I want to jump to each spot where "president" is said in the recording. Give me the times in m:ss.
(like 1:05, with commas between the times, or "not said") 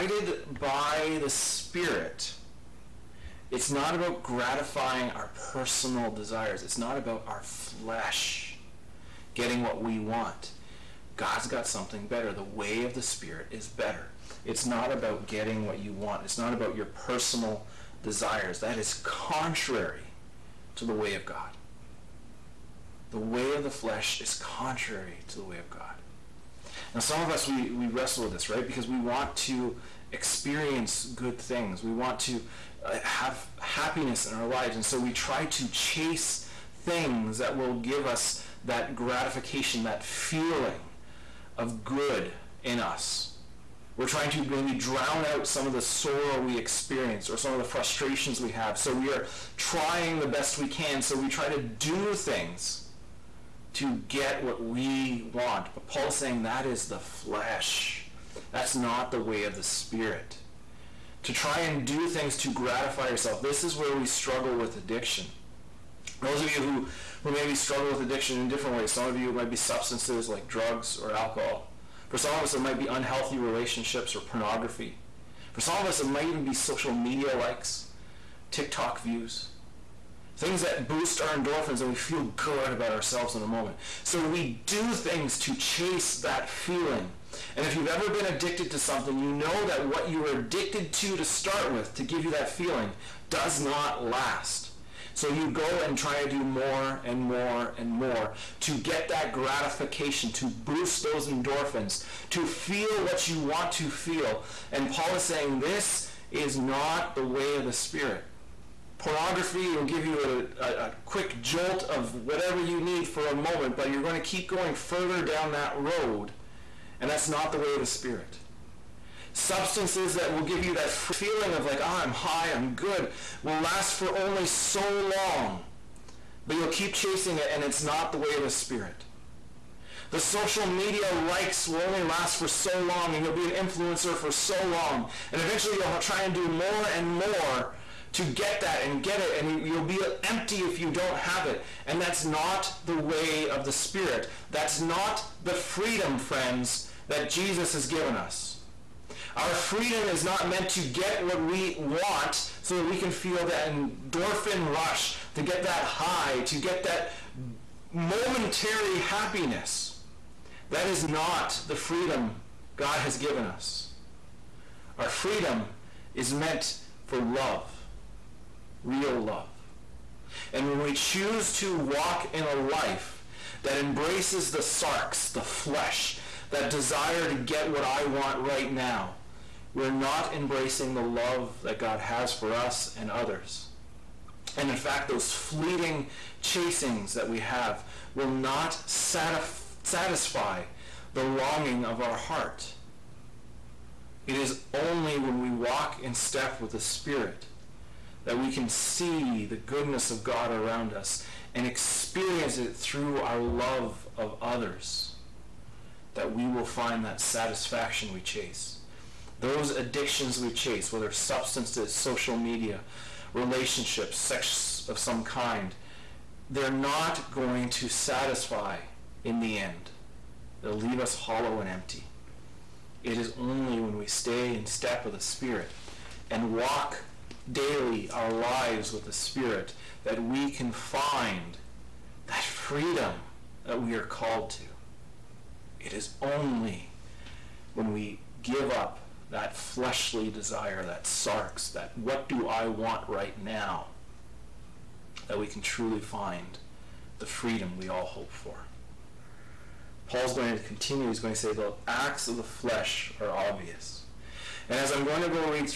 not said.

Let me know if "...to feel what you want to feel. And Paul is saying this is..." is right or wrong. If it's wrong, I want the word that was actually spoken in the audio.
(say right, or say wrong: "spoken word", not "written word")
right.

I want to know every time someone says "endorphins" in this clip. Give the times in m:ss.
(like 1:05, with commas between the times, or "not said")
1:21, 1:41, 2:33.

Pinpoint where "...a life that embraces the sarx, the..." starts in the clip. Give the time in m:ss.
2:52.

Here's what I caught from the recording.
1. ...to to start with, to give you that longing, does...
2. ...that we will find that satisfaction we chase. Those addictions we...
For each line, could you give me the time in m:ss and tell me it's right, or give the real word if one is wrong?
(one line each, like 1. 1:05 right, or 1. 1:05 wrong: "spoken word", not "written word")
1. 1:30 wrong: "feeling", not "longing"
2. 3:26 right.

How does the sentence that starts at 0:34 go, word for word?
And so we try to chase things that will give us that gratification, that feeling of good in us.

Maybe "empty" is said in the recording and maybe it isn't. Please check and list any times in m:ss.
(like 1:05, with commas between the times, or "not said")
2:20, 3:41.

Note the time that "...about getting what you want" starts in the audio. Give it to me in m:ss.
0:14.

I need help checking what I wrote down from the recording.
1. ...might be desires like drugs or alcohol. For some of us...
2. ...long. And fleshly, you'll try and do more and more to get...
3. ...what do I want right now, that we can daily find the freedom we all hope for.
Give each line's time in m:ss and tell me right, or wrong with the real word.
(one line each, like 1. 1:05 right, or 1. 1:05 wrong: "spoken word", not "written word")
1. 1:09 wrong: "substances", not "desires"
2. 2:14 wrong: "eventually", not "fleshly"
3. 4:02 wrong: "truly", not "daily".